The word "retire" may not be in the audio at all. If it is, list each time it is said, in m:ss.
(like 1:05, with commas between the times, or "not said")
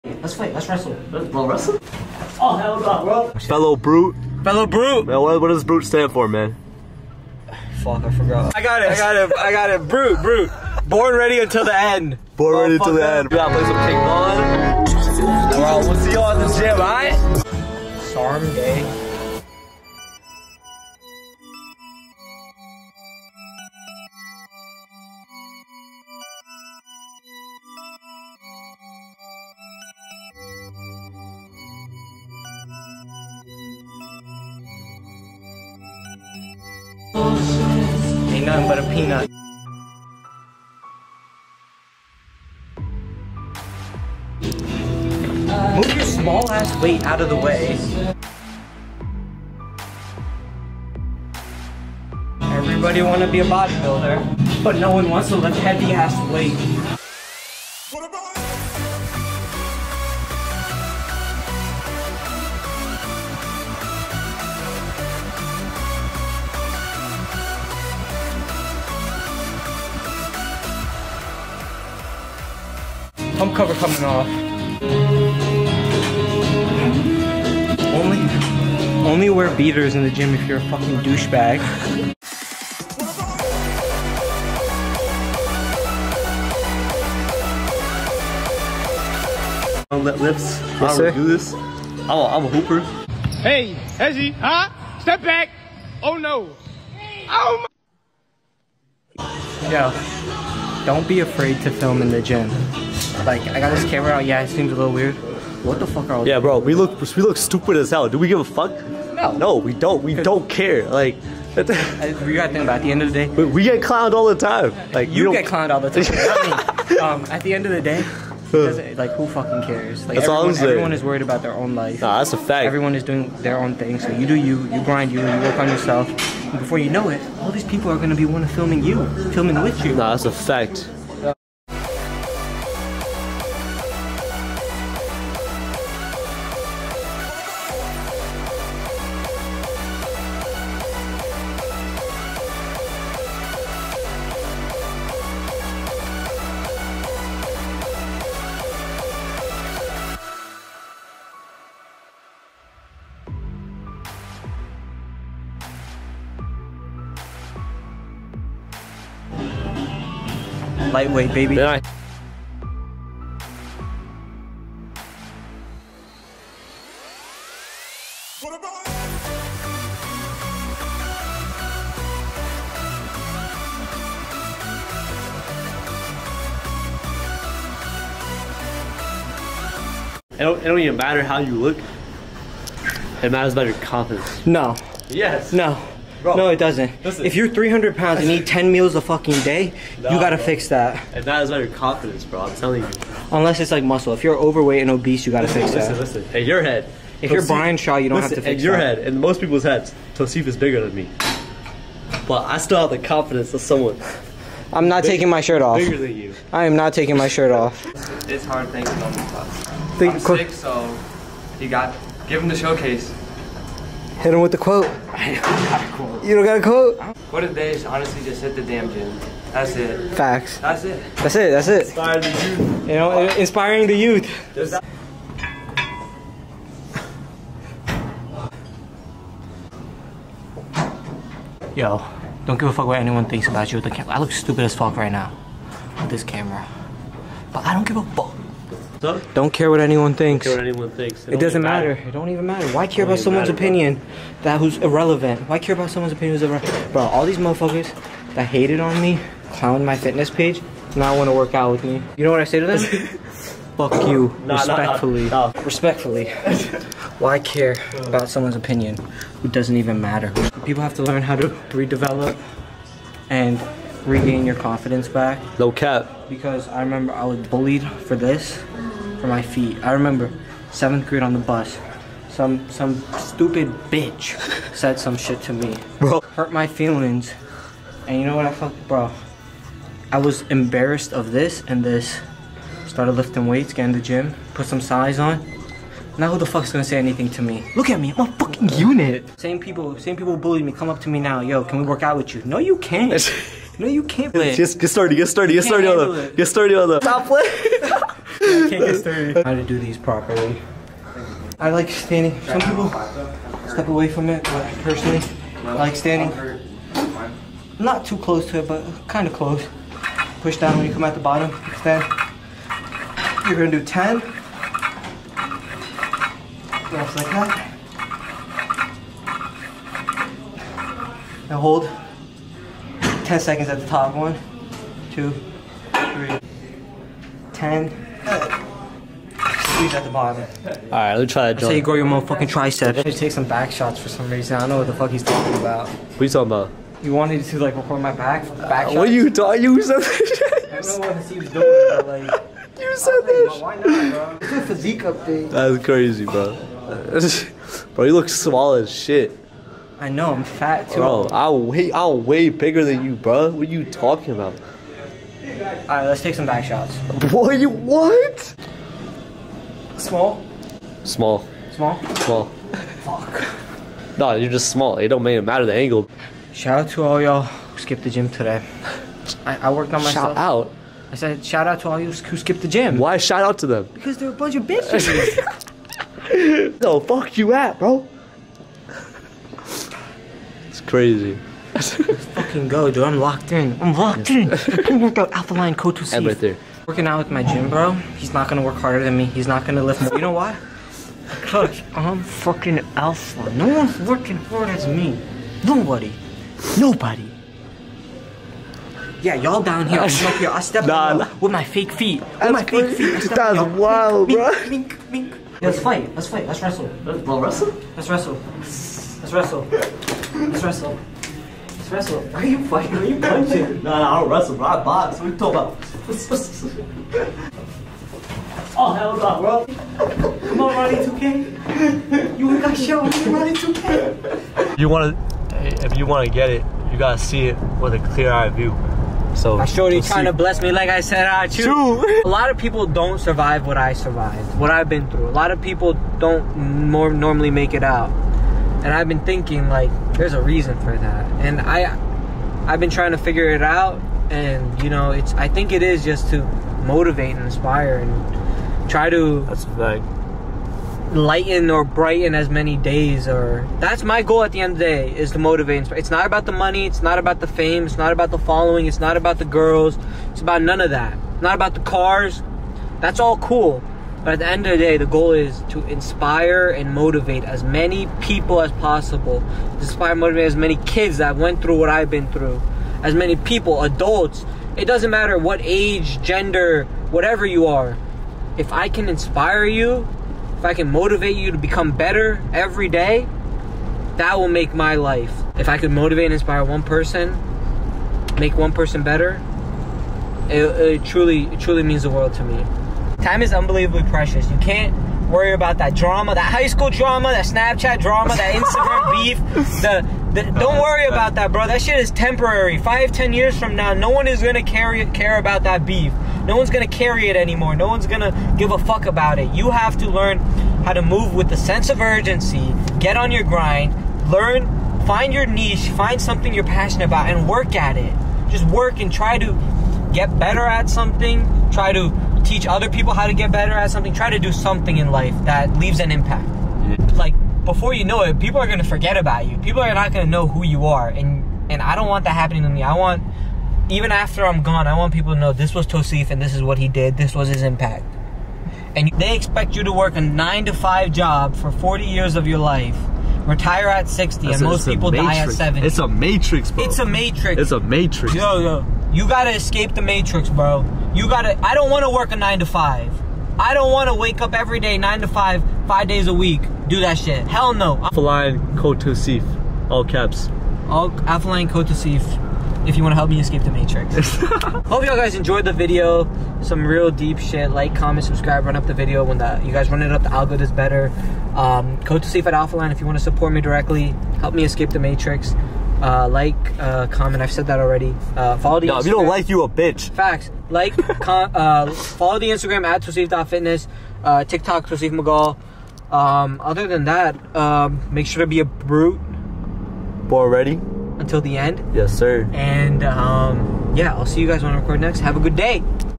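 9:03.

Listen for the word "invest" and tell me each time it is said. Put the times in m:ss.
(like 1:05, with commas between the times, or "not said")
not said.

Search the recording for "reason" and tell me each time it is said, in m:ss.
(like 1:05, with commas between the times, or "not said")
5:34, 7:20.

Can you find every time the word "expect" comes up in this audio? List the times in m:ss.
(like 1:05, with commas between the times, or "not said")
8:59.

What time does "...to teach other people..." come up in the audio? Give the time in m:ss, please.
8:41.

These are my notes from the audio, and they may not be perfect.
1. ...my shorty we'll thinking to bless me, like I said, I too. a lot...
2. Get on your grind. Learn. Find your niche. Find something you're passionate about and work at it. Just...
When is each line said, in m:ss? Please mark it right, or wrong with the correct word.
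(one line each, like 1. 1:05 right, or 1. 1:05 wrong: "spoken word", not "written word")
1. 7:09 wrong: "trying", not "thinking"
2. 8:32 right.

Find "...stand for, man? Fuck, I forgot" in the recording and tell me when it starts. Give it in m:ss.
0:05.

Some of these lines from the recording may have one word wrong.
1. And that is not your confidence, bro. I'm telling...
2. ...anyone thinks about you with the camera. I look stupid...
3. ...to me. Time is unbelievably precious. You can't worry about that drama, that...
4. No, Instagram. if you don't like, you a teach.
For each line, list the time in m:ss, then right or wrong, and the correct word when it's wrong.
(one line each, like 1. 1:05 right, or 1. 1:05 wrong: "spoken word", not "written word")
1. 3:11 right
2. 3:52 right
3. 8:12 right
4. 9:38 wrong: "bitch", not "teach".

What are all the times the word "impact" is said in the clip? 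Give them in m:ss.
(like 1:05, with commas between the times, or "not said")
8:46, 8:57.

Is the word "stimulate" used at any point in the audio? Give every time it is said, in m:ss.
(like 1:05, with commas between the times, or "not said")
not said.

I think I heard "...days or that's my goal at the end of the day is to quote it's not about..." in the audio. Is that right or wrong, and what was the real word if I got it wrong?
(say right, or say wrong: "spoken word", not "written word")
wrong: "motivate", not "quote".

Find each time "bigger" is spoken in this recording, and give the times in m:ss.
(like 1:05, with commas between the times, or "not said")
3:20, 3:25, 5:52.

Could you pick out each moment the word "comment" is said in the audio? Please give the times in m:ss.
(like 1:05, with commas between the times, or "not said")
9:27, 9:37.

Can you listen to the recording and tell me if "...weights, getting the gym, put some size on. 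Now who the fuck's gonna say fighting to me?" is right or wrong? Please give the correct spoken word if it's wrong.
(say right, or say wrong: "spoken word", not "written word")
wrong: "anything", not "fighting".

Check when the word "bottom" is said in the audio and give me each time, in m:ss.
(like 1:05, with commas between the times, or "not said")
5:11, 5:30.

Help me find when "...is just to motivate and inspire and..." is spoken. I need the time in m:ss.
7:25.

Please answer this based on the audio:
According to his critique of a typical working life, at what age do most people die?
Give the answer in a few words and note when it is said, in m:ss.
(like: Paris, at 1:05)
70, at 9:05.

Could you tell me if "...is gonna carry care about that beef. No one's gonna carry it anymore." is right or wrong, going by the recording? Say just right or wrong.
right.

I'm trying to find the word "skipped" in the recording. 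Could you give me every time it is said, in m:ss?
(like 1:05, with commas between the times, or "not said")
6:07, 6:12.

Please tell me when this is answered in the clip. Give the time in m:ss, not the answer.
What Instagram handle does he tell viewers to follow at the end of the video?
9:43.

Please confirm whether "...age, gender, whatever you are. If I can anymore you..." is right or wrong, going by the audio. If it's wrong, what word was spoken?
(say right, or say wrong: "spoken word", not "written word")
wrong: "inspire", not "anymore".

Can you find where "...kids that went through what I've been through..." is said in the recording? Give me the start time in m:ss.
7:50.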